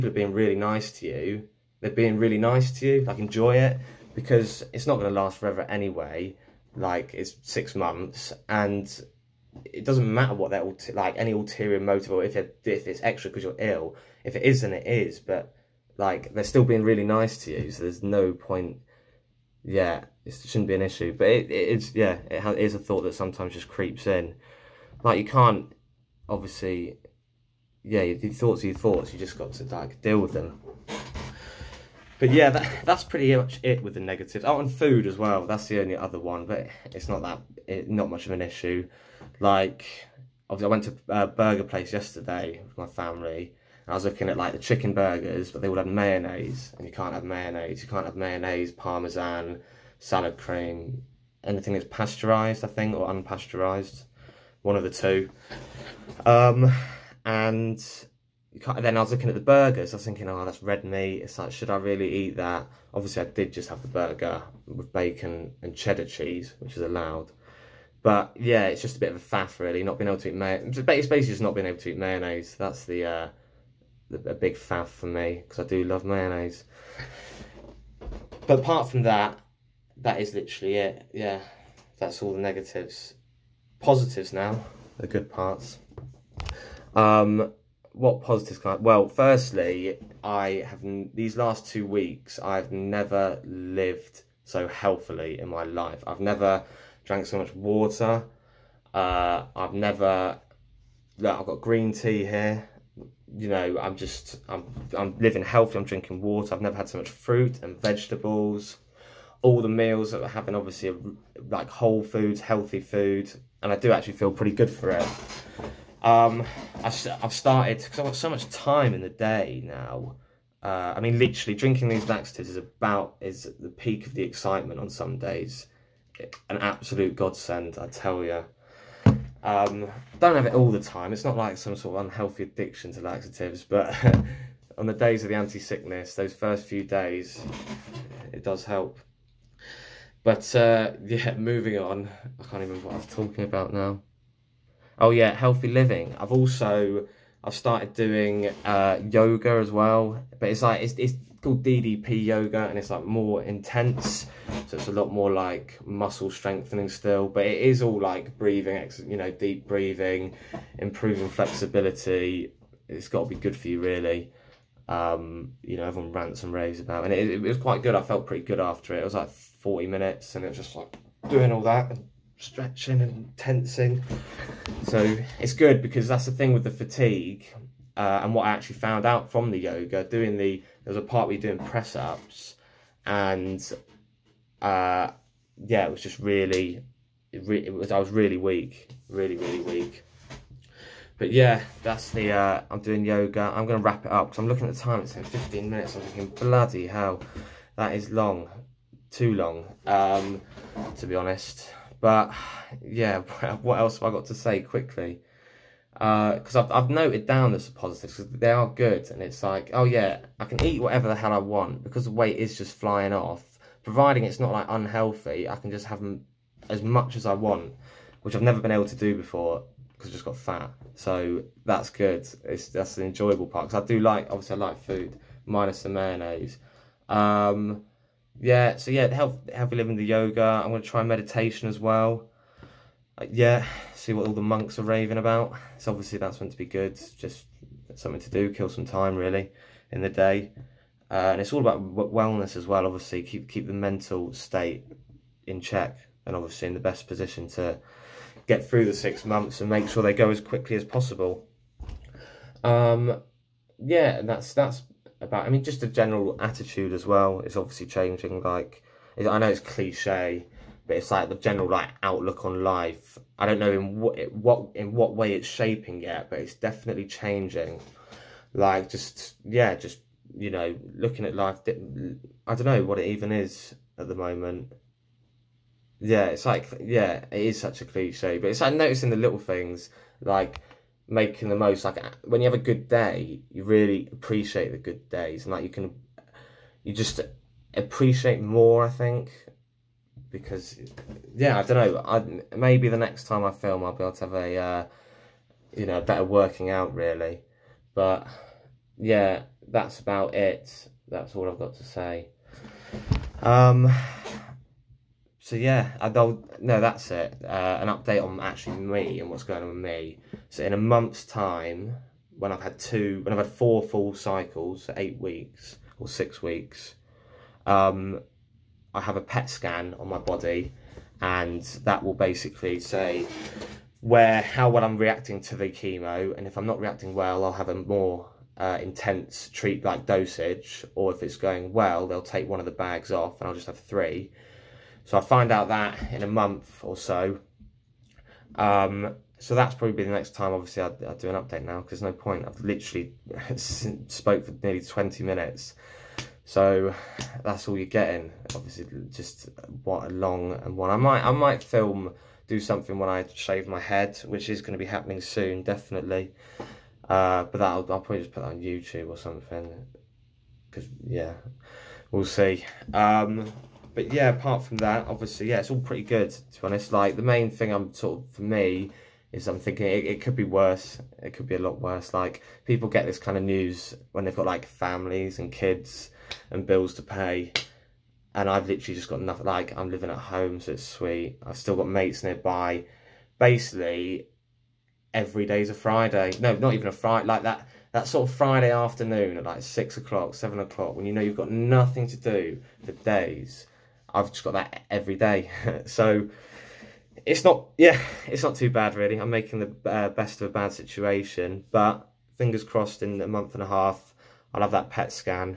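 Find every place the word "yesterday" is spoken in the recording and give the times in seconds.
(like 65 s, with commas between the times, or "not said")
41 s.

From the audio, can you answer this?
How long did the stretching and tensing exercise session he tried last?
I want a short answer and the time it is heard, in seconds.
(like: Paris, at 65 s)
40 minutes, at 169 s.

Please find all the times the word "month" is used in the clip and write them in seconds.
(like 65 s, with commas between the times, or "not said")
7 s, 249 s, 310 s, 336 s, 403 s.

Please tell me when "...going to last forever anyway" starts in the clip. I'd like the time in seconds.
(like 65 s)
4 s.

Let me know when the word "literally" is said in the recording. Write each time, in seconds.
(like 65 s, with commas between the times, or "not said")
80 s, 121 s, 342 s, 378 s.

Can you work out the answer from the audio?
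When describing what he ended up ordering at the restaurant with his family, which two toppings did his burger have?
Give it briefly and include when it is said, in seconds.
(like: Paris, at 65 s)
bacon and cheddar cheese, at 64 s.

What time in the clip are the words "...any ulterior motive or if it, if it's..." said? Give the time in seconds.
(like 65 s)
11 s.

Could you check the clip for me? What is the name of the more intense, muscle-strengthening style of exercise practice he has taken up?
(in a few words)
DDP yoga.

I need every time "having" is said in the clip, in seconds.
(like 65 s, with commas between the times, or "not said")
110 s.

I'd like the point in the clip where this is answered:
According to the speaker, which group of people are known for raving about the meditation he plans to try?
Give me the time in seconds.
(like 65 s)
234 s.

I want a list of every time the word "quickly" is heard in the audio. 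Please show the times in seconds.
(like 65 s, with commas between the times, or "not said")
204 s, 250 s.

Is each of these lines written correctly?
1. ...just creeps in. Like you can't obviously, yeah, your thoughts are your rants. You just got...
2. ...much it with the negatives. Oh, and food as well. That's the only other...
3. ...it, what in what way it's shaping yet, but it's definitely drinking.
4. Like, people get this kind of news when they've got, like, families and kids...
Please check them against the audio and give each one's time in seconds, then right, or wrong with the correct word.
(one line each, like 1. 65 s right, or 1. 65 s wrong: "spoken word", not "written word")
1. 23 s wrong: "thoughts", not "rants"
2. 33 s right
3. 264 s wrong: "changing", not "drinking"
4. 372 s right.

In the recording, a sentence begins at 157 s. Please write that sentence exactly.
But it is all like breathing, you know, deep breathing, improving flexibility.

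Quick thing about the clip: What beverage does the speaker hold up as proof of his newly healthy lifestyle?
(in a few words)
green tea.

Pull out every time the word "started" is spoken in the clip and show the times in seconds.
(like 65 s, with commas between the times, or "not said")
117 s, 147 s.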